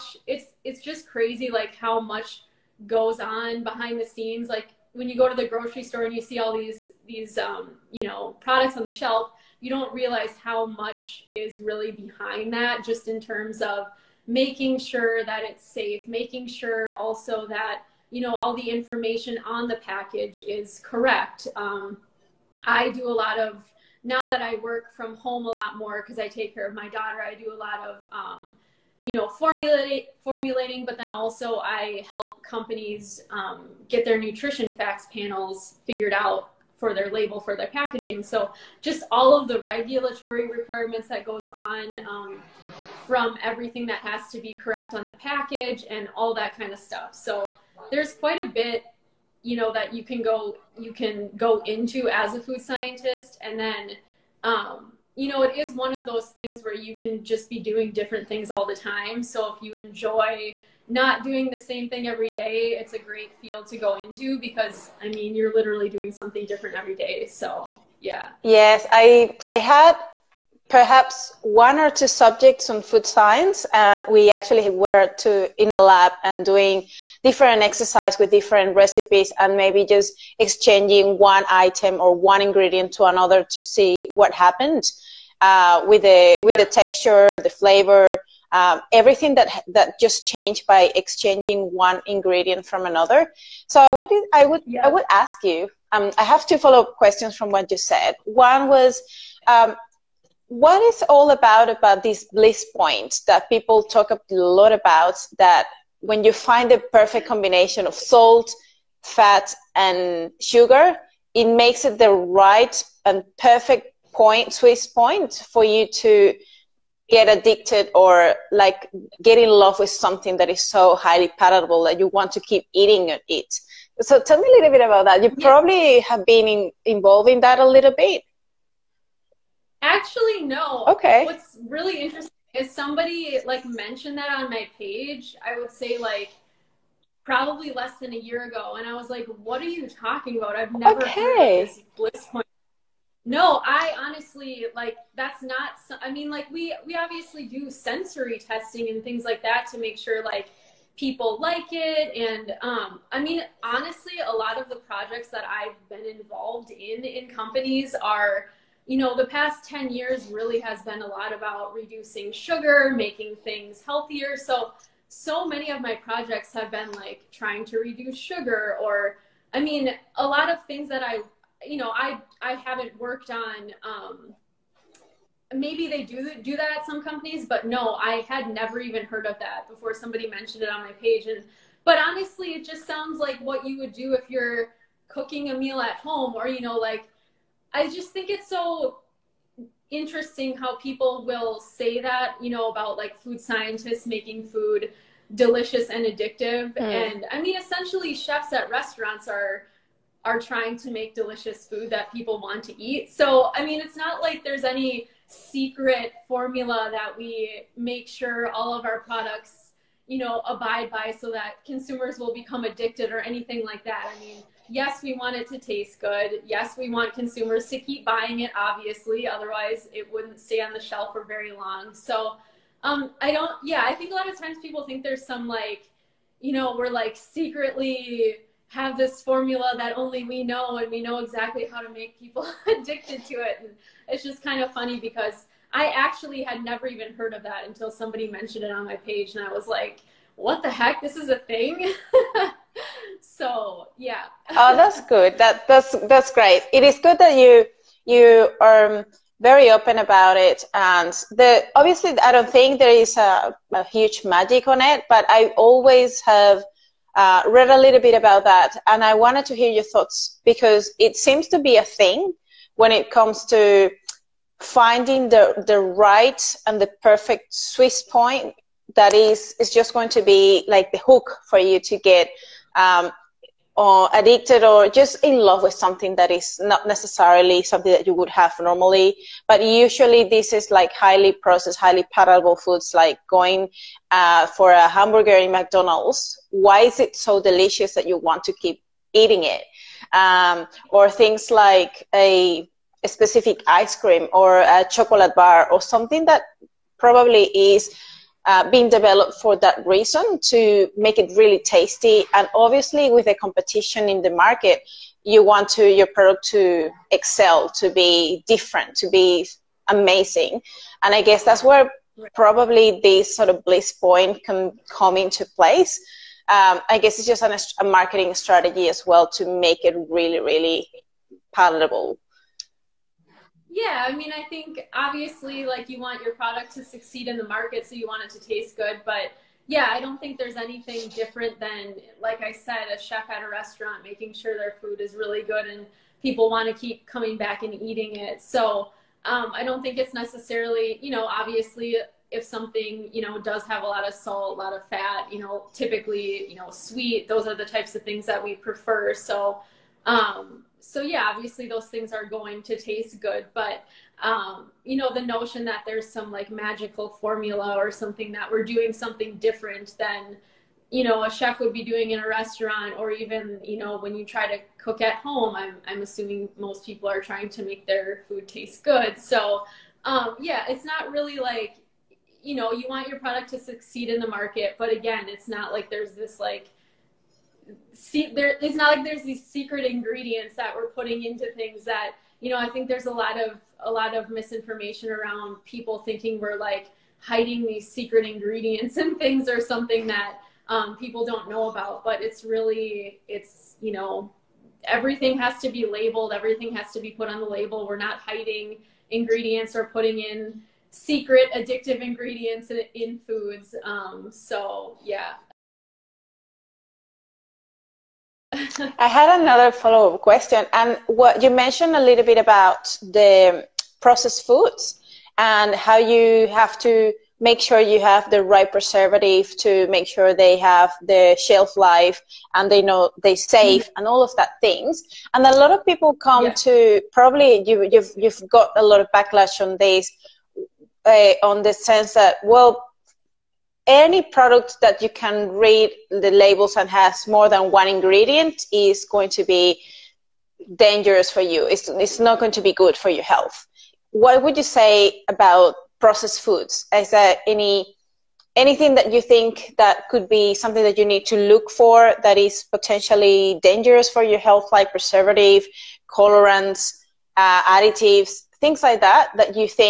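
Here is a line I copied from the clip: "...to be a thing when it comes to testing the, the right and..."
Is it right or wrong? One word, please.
wrong.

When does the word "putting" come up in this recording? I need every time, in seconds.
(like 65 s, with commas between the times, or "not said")
380 s, 399 s.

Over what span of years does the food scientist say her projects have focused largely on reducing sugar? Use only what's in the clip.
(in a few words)
past 10 years.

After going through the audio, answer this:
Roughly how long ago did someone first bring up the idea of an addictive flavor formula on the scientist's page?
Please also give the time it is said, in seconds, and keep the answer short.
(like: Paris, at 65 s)
less than a year ago, at 137 s.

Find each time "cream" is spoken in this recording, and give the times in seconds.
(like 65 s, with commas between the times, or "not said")
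293 s.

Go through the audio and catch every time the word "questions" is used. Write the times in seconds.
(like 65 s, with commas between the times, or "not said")
96 s, 410 s.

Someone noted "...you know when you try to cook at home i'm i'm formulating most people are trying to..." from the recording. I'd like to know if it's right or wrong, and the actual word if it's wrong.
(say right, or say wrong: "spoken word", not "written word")
wrong: "assuming", not "formulating".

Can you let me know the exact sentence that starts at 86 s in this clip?
the texture, the flavor, um, everything that that just changed by exchanging one ingredient from another.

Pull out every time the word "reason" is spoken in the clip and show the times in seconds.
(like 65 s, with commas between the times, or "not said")
299 s.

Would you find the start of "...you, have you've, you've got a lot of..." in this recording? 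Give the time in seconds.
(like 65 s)
427 s.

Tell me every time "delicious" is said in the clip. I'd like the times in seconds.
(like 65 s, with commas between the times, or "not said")
195 s, 201 s, 287 s.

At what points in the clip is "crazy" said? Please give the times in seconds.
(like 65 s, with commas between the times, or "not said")
1 s.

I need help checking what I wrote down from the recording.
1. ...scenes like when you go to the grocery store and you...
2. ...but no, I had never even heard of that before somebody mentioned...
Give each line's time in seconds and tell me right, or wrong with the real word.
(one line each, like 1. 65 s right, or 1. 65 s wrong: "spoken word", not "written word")
1. 4 s right
2. 177 s right.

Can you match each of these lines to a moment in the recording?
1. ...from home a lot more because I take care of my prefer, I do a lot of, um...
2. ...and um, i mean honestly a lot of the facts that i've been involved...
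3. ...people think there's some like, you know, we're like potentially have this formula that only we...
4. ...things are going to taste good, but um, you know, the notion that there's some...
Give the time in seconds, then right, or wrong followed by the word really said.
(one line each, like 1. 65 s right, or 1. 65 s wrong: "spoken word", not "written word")
1. 24 s wrong: "daughter", not "prefer"
2. 152 s wrong: "projects", not "facts"
3. 224 s wrong: "secretly", not "potentially"
4. 351 s right.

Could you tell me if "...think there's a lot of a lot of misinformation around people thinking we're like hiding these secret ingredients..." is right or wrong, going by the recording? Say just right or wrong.
right.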